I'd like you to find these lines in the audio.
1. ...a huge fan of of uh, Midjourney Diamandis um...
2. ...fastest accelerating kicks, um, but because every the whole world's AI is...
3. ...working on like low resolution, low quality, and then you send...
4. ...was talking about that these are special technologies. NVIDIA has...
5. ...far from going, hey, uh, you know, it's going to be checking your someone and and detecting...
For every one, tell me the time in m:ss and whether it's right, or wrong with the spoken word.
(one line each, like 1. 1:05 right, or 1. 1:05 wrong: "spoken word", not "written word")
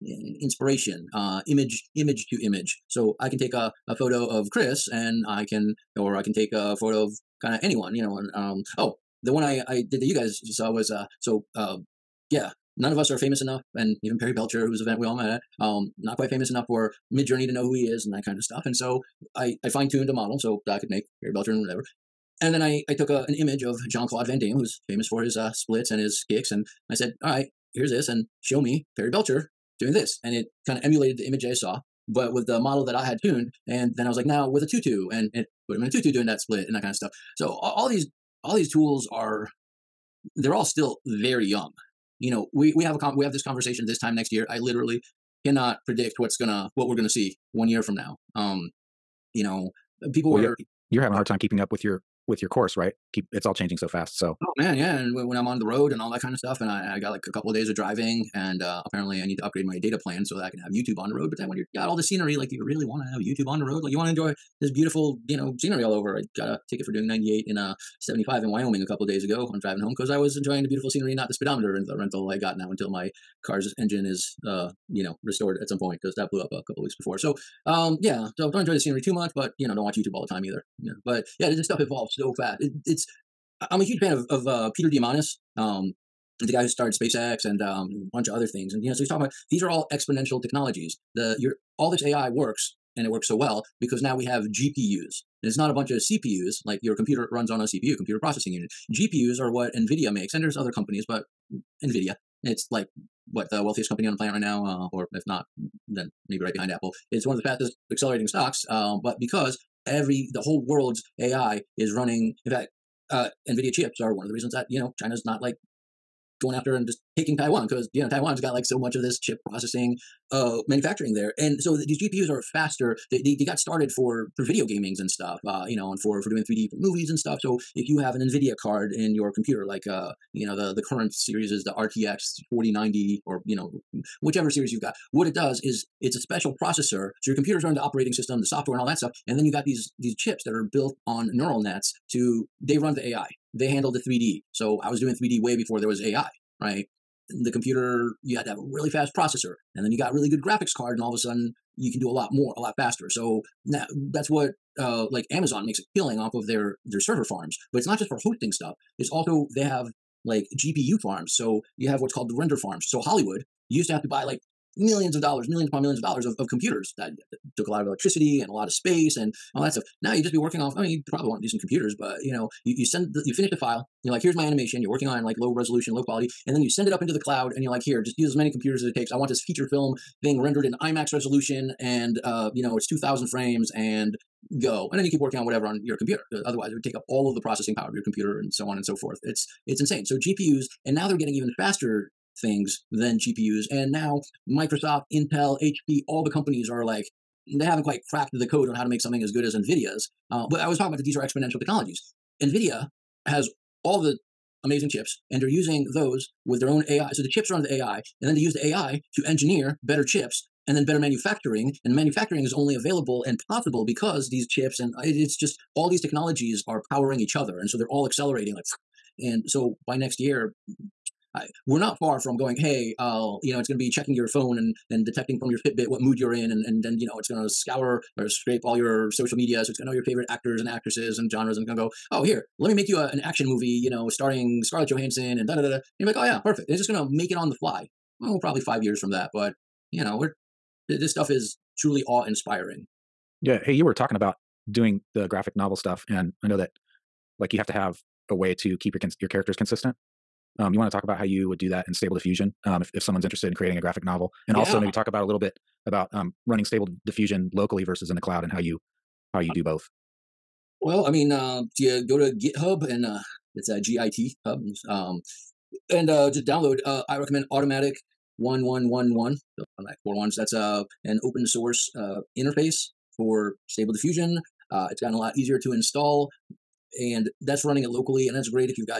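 1. 1:23 wrong: "Peter", not "Midjourney"
2. 1:47 wrong: "stocks", not "kicks"
3. 2:54 right
4. 3:20 wrong: "exponential", not "special"
5. 3:41 wrong: "phone", not "someone".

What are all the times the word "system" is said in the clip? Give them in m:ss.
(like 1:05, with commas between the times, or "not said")
2:18.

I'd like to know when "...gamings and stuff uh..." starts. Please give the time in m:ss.
2:04.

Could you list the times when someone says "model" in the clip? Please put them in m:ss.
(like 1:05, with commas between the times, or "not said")
0:20, 0:32.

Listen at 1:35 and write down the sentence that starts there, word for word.
it's not a bunch of CPUs like your computer runs on a CPU, computer processing unit.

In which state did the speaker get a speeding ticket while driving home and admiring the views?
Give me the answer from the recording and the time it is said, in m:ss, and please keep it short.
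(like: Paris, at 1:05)
Wyoming, at 1:08.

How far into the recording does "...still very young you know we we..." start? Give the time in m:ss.
0:40.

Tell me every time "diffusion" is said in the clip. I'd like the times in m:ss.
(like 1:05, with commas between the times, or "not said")
4:12, 4:17, 4:33.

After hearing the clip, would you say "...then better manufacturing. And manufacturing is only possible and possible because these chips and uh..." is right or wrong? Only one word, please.
wrong.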